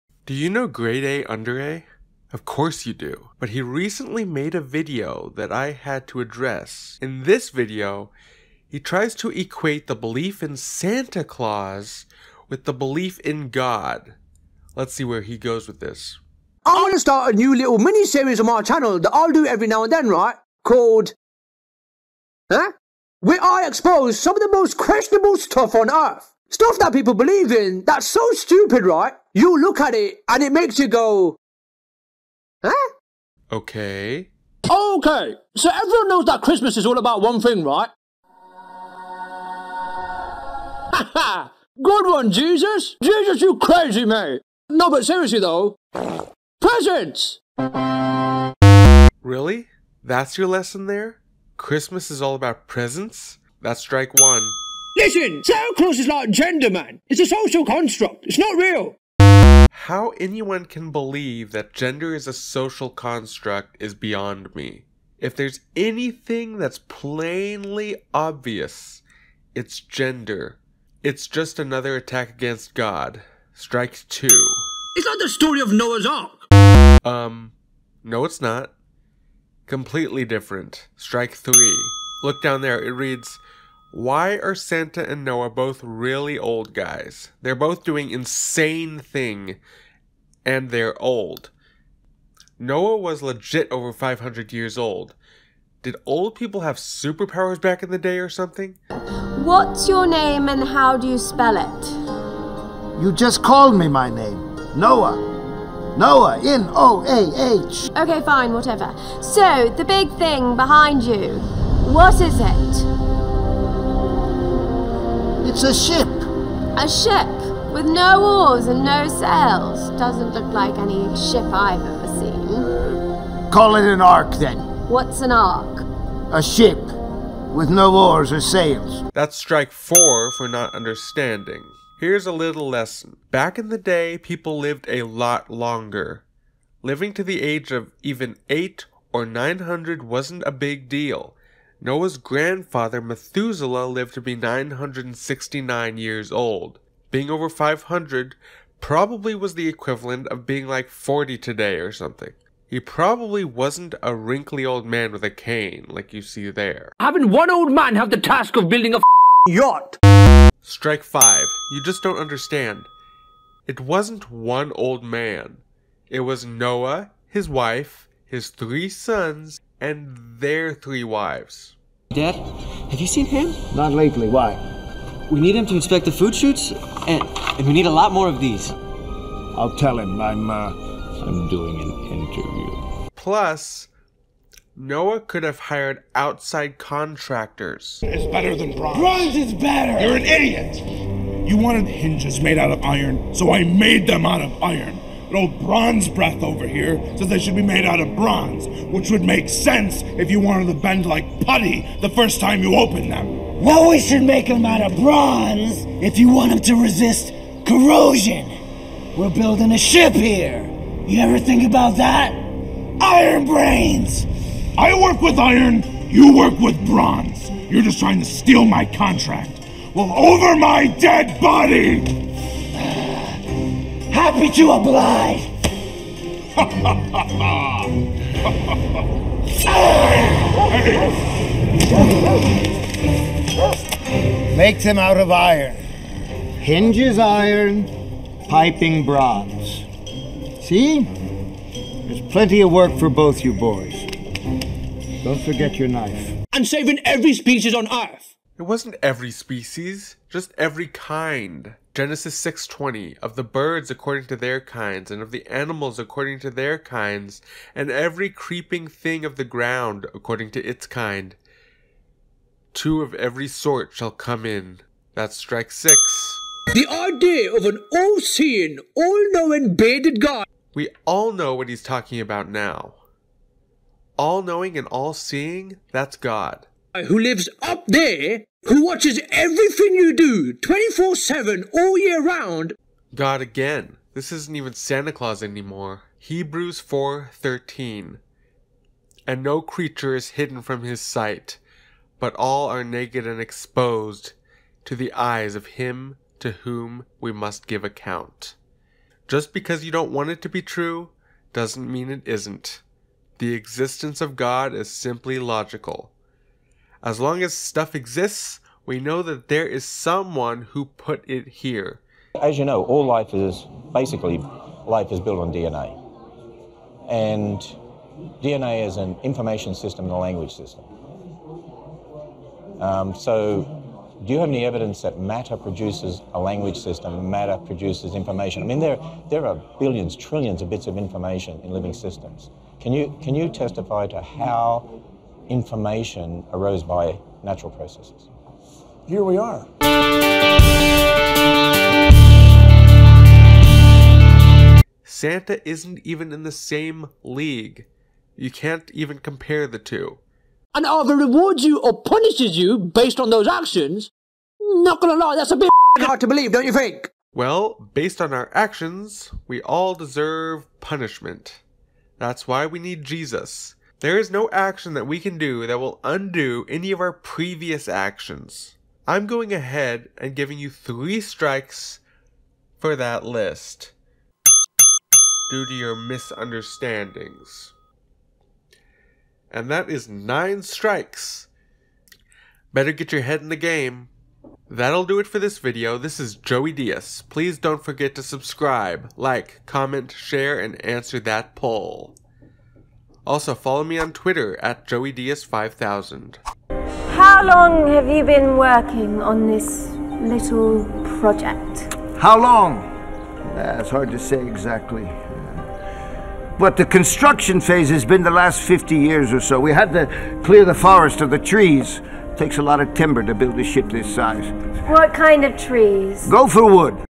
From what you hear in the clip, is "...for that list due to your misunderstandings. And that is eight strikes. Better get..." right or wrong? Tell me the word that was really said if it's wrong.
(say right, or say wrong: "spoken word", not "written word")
wrong: "nine", not "eight".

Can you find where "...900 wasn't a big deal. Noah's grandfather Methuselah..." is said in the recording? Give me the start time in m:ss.
2:19.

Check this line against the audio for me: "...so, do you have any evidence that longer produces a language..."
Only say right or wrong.
wrong.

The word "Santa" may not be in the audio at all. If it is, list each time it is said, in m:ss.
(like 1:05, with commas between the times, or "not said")
0:10, 0:55, 1:24, 4:44, 5:45.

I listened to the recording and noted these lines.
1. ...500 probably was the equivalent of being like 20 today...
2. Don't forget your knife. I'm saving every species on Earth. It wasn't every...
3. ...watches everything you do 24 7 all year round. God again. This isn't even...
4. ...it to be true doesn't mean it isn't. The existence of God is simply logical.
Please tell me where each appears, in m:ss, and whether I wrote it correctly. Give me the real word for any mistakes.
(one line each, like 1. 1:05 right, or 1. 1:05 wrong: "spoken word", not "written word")
1. 2:27 wrong: "40", not "20"
2. 4:05 right
3. 4:38 right
4. 5:00 right.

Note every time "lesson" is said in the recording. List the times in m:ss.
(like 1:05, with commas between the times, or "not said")
0:50, 2:12.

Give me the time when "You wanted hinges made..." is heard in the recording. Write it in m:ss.
3:11.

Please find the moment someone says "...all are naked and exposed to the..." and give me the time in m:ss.
4:52.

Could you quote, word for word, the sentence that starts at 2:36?
Having one old man have the task of building a yacht.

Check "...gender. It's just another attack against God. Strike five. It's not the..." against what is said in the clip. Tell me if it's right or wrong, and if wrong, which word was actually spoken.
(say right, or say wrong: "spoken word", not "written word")
wrong: "two", not "five".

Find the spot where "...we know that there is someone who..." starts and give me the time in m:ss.
5:08.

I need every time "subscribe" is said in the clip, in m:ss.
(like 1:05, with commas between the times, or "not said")
6:28.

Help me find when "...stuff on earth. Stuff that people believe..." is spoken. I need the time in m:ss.
0:25.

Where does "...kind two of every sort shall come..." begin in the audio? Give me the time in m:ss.
4:20.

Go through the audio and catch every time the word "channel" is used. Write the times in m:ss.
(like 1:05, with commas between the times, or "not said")
0:18.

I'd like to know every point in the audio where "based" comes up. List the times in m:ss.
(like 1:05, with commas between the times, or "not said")
5:52, 5:57.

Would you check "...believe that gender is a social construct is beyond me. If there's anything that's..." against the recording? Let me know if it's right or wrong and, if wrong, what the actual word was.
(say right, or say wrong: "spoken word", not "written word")
right.